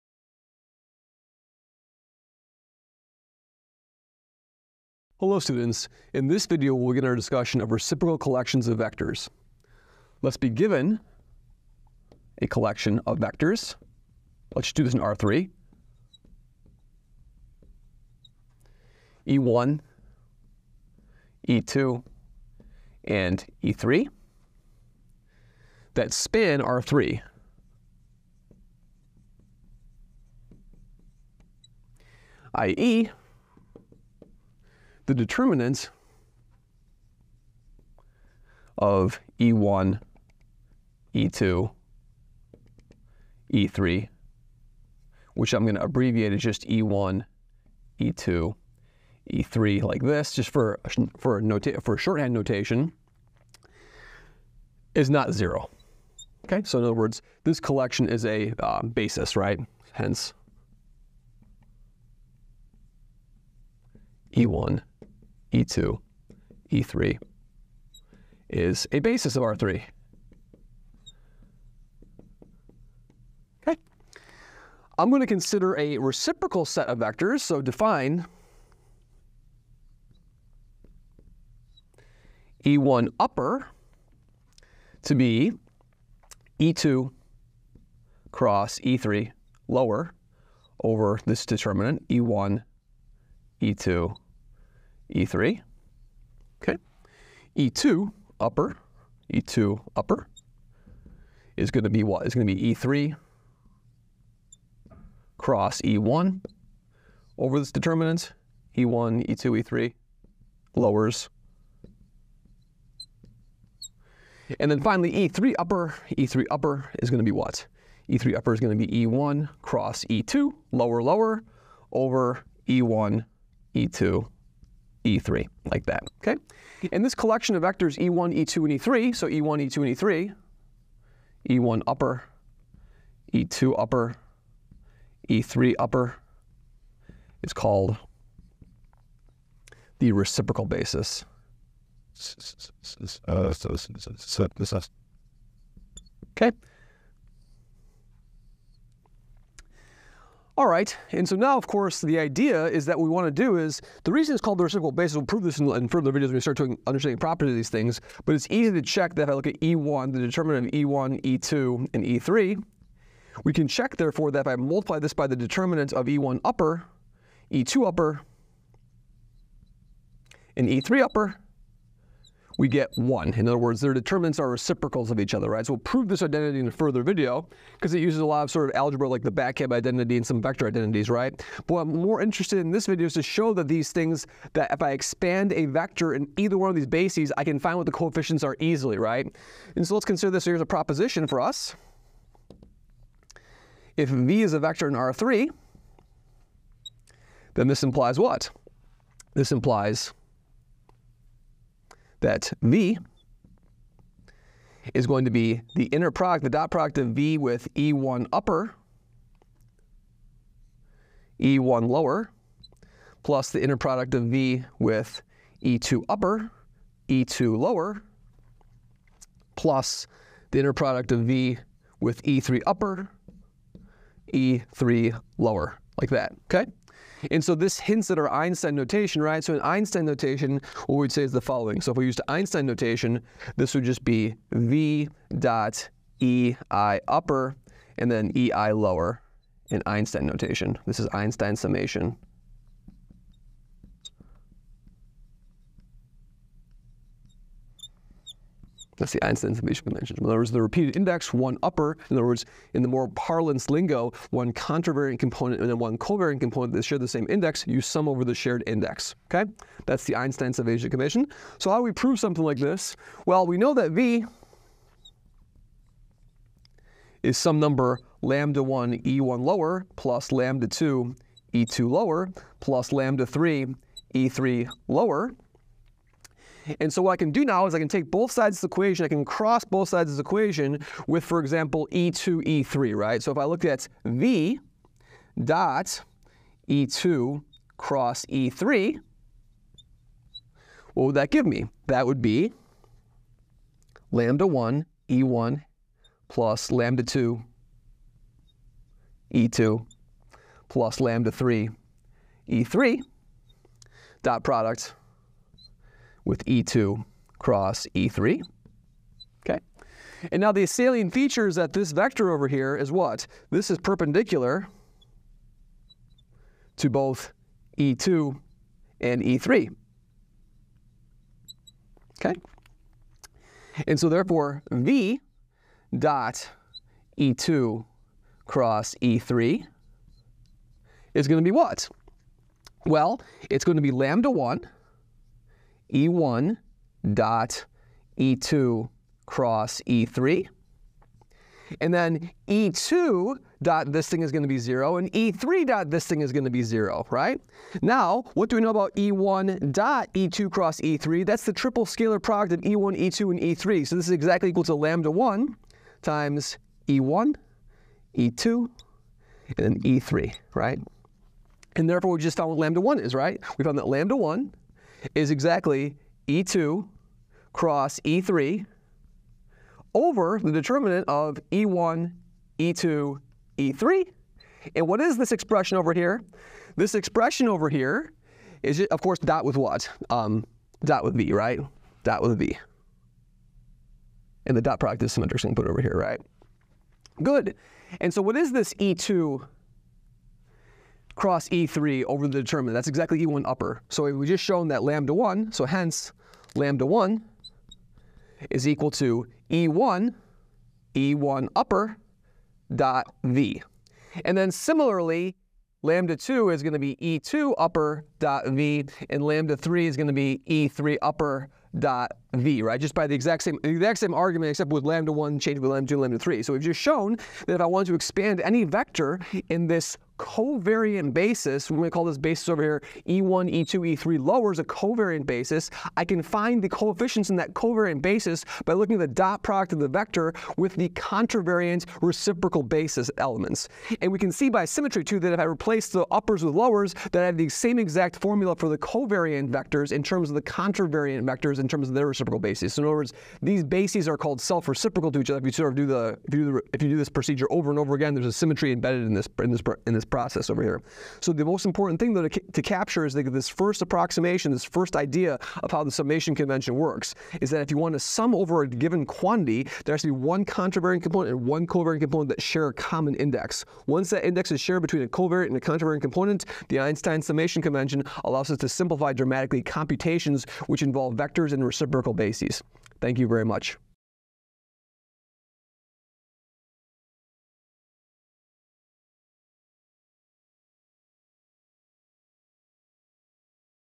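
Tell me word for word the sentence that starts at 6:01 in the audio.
And therefore, we just found what lambda 1 is, right?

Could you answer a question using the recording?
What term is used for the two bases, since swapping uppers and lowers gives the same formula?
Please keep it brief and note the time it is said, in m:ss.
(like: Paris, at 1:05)
Self-reciprocal, at 7:24.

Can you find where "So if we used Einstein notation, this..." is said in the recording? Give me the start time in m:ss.
3:51.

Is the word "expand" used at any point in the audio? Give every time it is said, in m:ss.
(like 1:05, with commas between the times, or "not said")
3:04, 6:57.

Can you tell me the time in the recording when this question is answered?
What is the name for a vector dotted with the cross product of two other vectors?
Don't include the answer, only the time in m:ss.
5:51.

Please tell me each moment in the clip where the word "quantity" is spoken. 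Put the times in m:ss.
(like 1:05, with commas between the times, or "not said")
7:39.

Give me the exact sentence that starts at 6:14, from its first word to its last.
And what is this expression over here?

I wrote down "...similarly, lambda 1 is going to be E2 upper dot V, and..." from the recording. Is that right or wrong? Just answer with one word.
wrong.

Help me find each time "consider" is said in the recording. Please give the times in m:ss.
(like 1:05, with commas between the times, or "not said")
1:15, 3:10.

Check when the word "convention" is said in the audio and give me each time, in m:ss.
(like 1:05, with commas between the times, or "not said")
4:09, 4:20, 7:36, 7:47.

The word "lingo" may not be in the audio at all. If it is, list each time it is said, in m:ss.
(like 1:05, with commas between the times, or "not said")
4:13.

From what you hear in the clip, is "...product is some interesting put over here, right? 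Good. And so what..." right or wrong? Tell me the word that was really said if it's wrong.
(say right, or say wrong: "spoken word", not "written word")
right.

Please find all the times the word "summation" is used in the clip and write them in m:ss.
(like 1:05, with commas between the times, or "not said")
4:01, 4:09, 4:20, 7:35, 7:47.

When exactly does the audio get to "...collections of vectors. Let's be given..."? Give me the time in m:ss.
0:08.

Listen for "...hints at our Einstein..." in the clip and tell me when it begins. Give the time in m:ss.
3:47.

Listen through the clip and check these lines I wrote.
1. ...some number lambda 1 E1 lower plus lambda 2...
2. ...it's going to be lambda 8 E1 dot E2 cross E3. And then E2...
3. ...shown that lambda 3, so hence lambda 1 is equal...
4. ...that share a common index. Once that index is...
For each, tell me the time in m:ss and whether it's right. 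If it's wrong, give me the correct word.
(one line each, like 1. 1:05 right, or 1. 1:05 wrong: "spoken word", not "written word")
1. 4:27 right
2. 5:33 wrong: "1", not "8"
3. 6:34 wrong: "1", not "3"
4. 7:42 right.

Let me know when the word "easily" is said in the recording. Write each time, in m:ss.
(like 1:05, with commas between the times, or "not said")
3:08.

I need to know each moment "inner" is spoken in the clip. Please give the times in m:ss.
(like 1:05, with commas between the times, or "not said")
3:25, 3:33, 3:40.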